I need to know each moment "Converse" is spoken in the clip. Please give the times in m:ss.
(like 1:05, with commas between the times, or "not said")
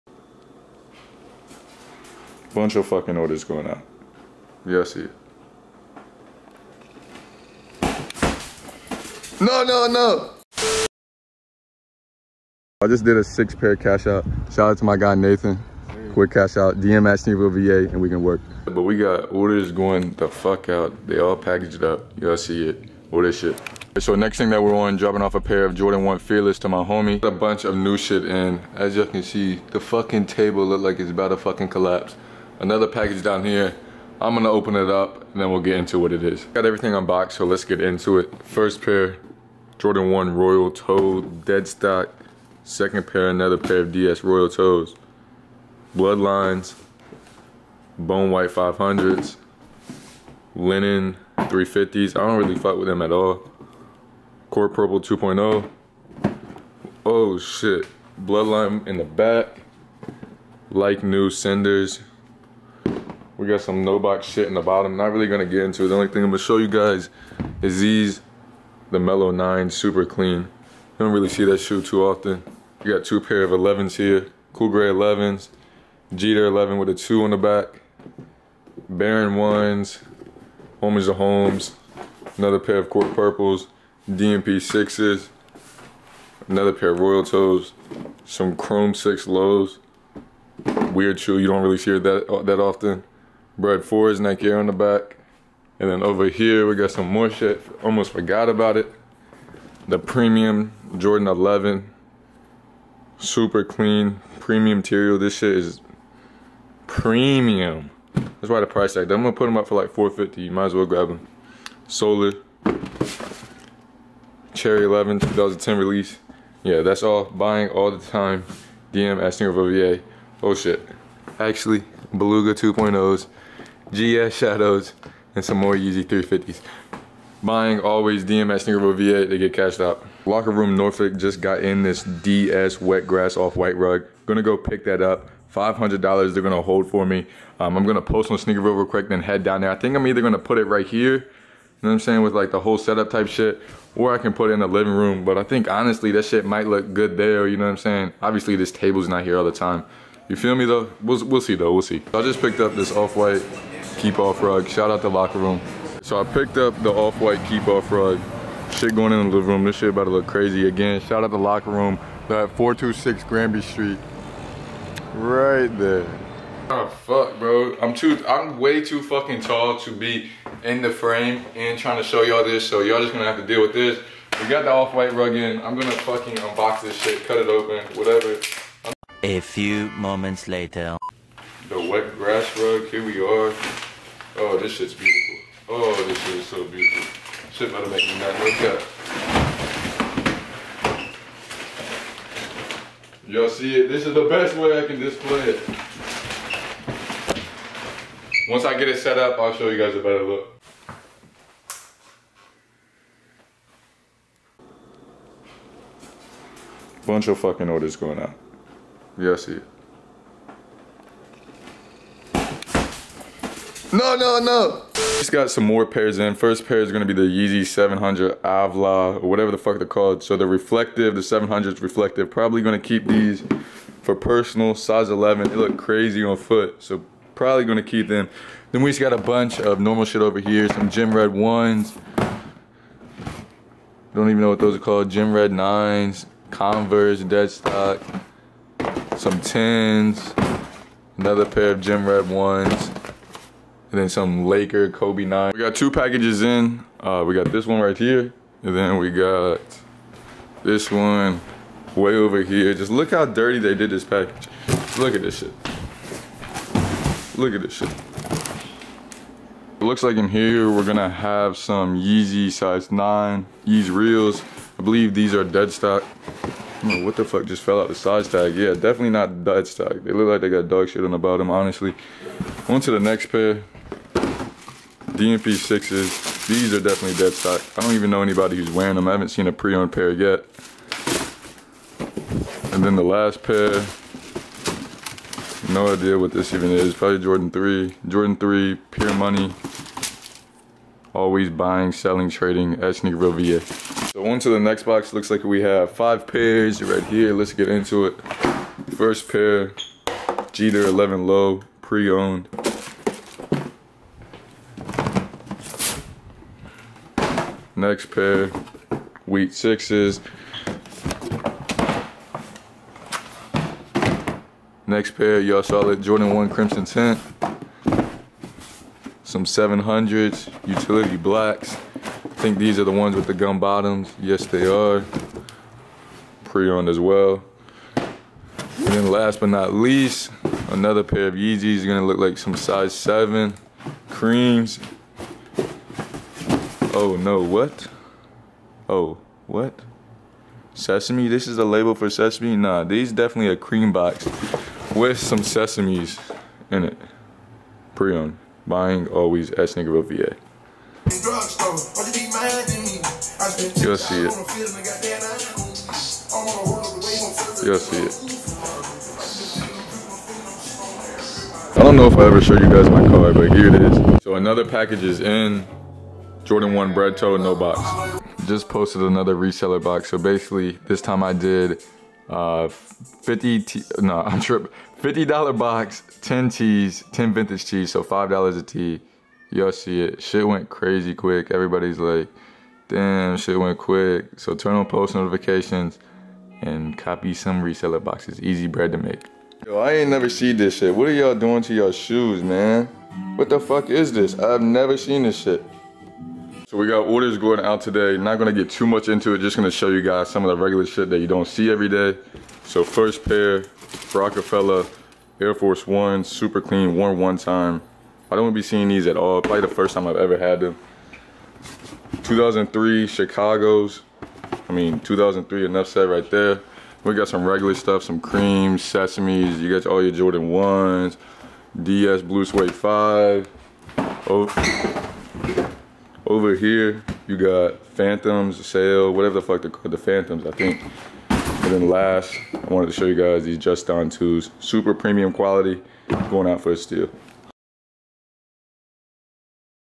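3:56.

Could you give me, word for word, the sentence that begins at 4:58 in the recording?
First pair, Jeter 11 low, pre-owned.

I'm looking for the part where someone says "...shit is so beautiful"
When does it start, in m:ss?
3:06.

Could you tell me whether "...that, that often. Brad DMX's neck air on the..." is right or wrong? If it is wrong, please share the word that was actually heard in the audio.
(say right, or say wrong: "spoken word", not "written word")
wrong: "Ford", not "DMX".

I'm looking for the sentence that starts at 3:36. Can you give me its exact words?
First pair is gonna be the Yeezy 700 Alvah, or whatever the fuck they're called.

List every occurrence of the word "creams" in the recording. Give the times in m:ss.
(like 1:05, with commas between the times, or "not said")
5:34, 5:43, 6:58.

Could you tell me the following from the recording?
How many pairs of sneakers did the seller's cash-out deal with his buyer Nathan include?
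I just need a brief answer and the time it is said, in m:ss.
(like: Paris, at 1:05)
6, at 0:13.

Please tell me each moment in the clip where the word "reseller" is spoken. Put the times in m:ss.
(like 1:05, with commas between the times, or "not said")
6:09, 6:27.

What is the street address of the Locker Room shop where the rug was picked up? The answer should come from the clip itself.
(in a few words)
426 Granby Street.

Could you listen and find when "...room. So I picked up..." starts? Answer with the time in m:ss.
2:35.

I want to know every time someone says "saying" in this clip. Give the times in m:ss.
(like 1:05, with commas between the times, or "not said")
2:22, 2:27.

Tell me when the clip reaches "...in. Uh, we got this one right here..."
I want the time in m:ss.
4:06.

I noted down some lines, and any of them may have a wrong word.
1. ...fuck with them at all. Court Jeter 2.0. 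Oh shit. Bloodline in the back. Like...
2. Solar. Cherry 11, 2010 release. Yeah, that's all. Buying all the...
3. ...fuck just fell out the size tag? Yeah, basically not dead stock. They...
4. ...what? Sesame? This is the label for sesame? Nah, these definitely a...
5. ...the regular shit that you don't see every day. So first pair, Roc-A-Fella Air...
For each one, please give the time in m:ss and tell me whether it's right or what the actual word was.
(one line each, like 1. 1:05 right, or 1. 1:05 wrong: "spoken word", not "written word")
1. 0:52 wrong: "Purple", not "Jeter"
2. 1:51 right
3. 4:27 wrong: "definitely", not "basically"
4. 5:39 right
5. 6:40 right.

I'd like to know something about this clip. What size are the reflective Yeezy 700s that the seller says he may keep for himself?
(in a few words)
11.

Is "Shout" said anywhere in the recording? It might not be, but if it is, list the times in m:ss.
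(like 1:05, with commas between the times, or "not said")
0:14, 2:34, 2:41.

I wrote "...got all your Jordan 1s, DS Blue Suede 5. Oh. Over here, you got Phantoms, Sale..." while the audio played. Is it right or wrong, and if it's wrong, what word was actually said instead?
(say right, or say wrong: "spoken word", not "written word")
right.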